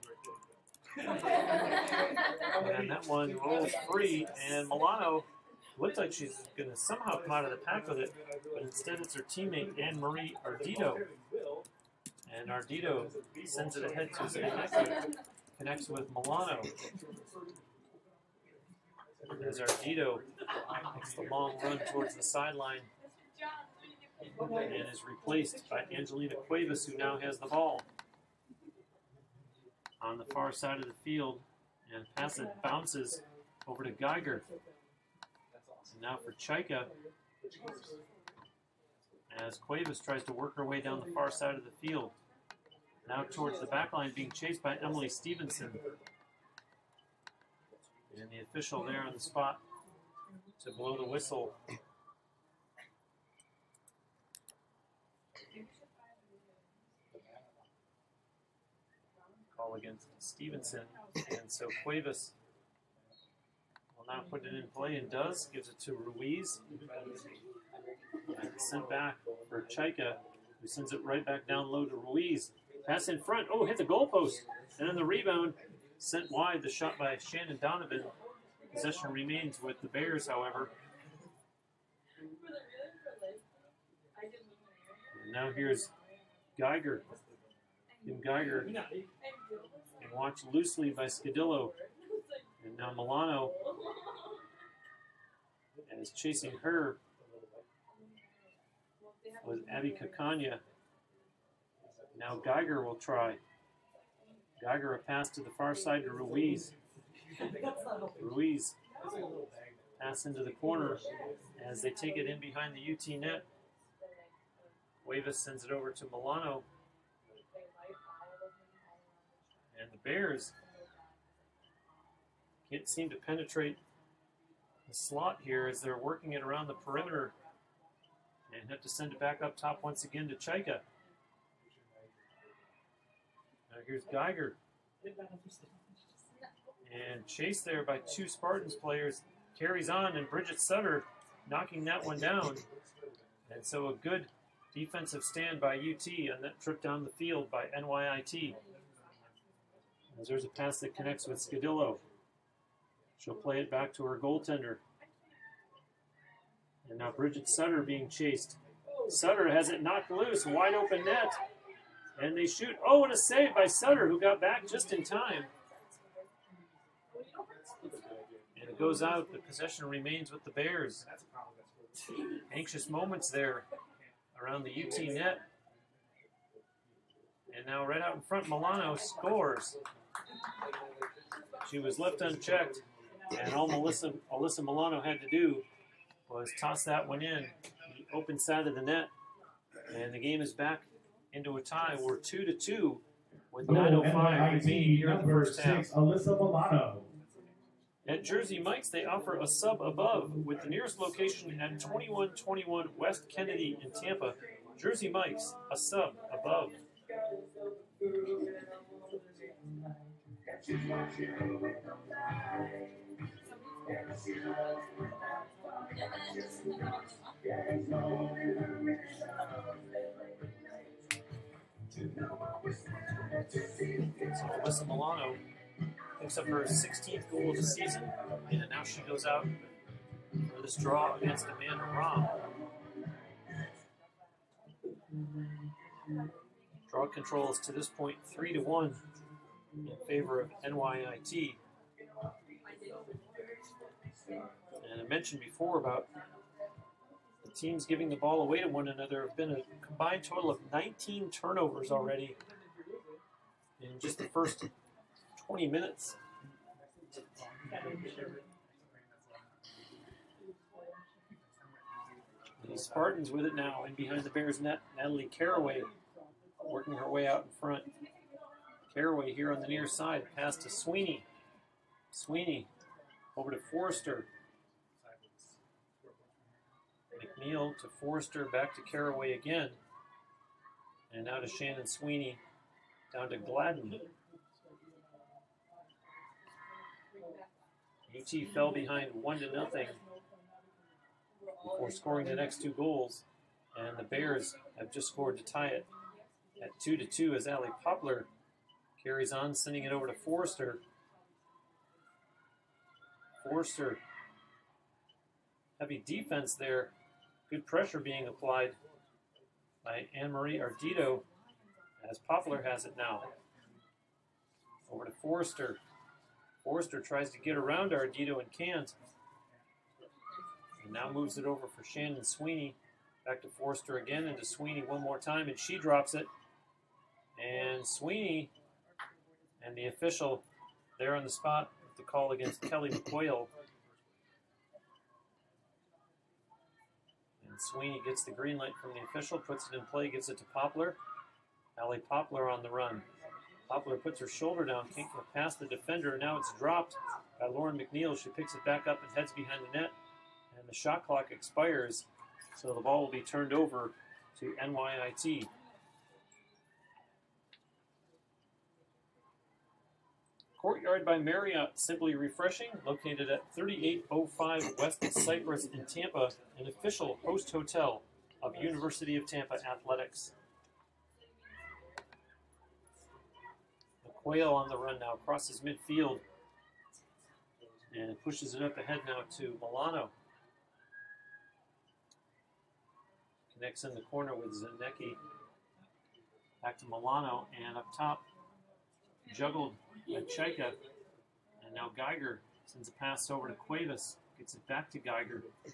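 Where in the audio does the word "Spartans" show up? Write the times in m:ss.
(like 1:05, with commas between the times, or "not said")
2:18, 4:22.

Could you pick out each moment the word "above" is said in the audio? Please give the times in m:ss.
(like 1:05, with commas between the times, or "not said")
3:19, 3:26.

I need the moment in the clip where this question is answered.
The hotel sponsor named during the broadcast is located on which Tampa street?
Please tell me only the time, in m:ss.
6:04.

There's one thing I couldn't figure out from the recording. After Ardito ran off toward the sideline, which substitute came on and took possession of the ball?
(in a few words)
Angelina Cuevas.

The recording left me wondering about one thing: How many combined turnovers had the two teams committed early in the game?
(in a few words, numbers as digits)
19.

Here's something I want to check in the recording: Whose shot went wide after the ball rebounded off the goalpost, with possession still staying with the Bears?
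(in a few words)
Shannon Donovan.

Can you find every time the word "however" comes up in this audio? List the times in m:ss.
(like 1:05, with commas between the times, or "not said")
1:20.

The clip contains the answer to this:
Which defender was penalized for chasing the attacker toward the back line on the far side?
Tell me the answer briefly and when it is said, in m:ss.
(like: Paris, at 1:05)
Emily Stevenson, at 0:44.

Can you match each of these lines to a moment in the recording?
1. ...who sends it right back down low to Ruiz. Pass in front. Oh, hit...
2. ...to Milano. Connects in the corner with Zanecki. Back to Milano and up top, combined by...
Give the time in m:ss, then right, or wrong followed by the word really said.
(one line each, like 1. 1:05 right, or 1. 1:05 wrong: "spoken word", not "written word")
1. 1:10 right
2. 6:19 wrong: "juggled", not "combined".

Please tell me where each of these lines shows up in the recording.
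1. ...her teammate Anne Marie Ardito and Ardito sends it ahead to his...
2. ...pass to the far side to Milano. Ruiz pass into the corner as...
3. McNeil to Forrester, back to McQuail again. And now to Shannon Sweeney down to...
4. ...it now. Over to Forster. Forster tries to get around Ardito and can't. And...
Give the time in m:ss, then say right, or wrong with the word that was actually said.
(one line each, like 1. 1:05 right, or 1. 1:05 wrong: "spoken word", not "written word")
1. 0:09 right
2. 1:44 wrong: "Ruiz", not "Milano"
3. 4:37 wrong: "Caraway", not "McQuail"
4. 5:12 right.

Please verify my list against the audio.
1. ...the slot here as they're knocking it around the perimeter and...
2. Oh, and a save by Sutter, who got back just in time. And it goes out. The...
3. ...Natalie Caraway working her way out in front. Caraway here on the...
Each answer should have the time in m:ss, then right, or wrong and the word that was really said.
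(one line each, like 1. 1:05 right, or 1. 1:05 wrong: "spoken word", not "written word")
1. 2:04 wrong: "working", not "knocking"
2. 2:42 right
3. 4:24 right.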